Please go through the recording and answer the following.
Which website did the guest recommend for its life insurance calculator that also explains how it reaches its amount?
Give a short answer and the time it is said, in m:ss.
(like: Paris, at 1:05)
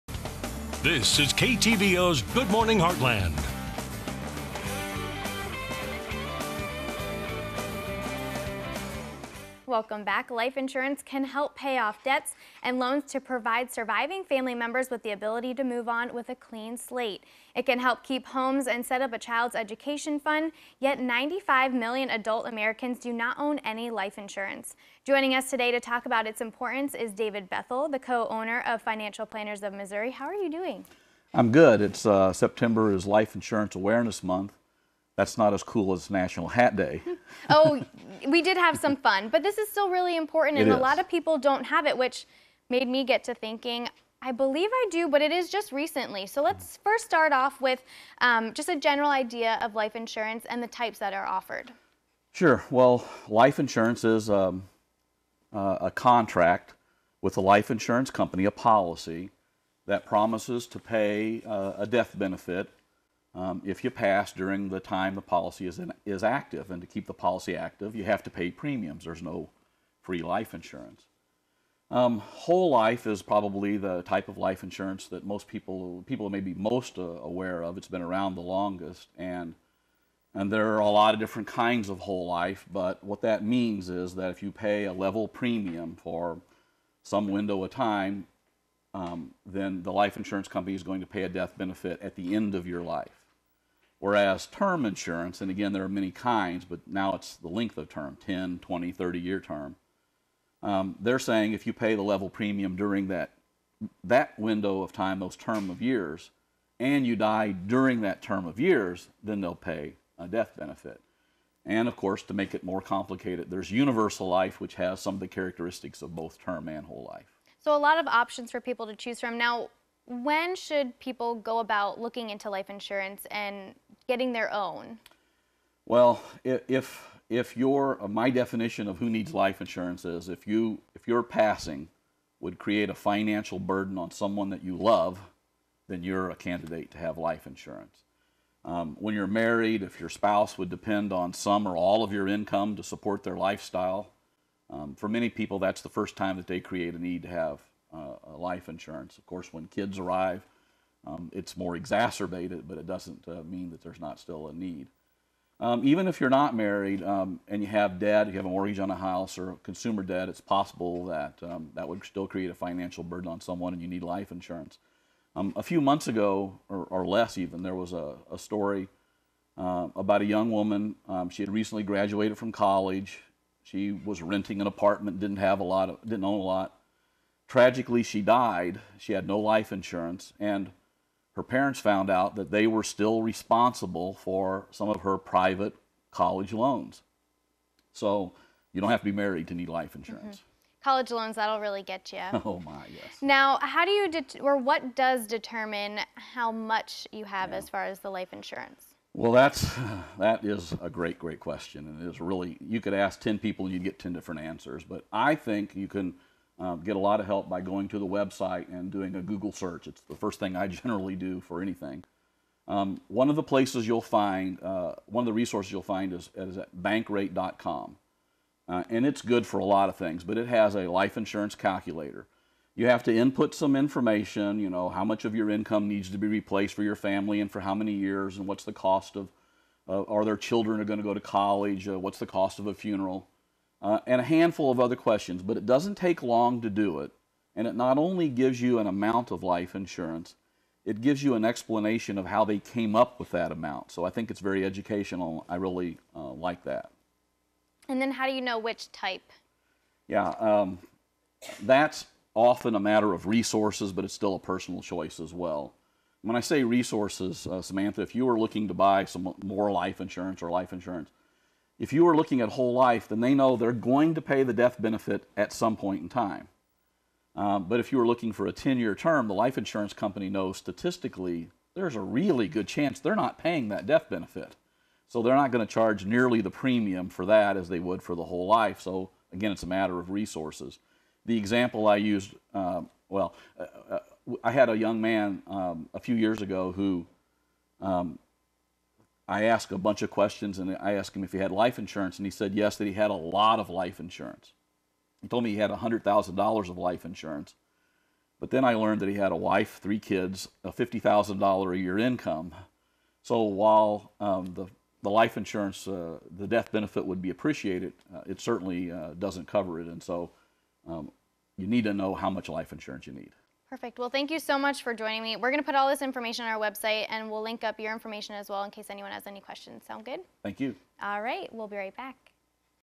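bankrate.com, at 3:36.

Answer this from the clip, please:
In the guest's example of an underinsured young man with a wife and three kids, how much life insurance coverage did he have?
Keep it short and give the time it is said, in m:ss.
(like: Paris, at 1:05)
$100,000, at 4:55.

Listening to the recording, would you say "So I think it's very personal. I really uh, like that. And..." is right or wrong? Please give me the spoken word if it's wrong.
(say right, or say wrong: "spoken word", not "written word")
wrong: "educational", not "personal".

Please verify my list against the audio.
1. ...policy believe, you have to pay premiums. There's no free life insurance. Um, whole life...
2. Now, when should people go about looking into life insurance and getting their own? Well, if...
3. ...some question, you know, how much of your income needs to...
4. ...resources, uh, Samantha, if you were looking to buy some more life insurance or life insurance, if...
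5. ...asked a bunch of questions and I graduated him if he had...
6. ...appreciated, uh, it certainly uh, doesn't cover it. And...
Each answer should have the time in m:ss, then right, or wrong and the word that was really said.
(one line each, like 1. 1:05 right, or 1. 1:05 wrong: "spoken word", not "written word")
1. 1:07 wrong: "active", not "believe"
2. 1:59 right
3. 3:43 wrong: "information", not "question"
4. 4:16 right
5. 4:49 wrong: "asked", not "graduated"
6. 5:07 right.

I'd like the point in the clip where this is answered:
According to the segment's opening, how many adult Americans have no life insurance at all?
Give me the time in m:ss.
0:20.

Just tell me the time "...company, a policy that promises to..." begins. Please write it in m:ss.
0:58.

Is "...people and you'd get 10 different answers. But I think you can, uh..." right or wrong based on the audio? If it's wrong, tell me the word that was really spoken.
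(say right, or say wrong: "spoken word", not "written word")
right.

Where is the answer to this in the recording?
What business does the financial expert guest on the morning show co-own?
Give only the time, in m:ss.
0:28.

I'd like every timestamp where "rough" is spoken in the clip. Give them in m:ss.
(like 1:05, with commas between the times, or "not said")
not said.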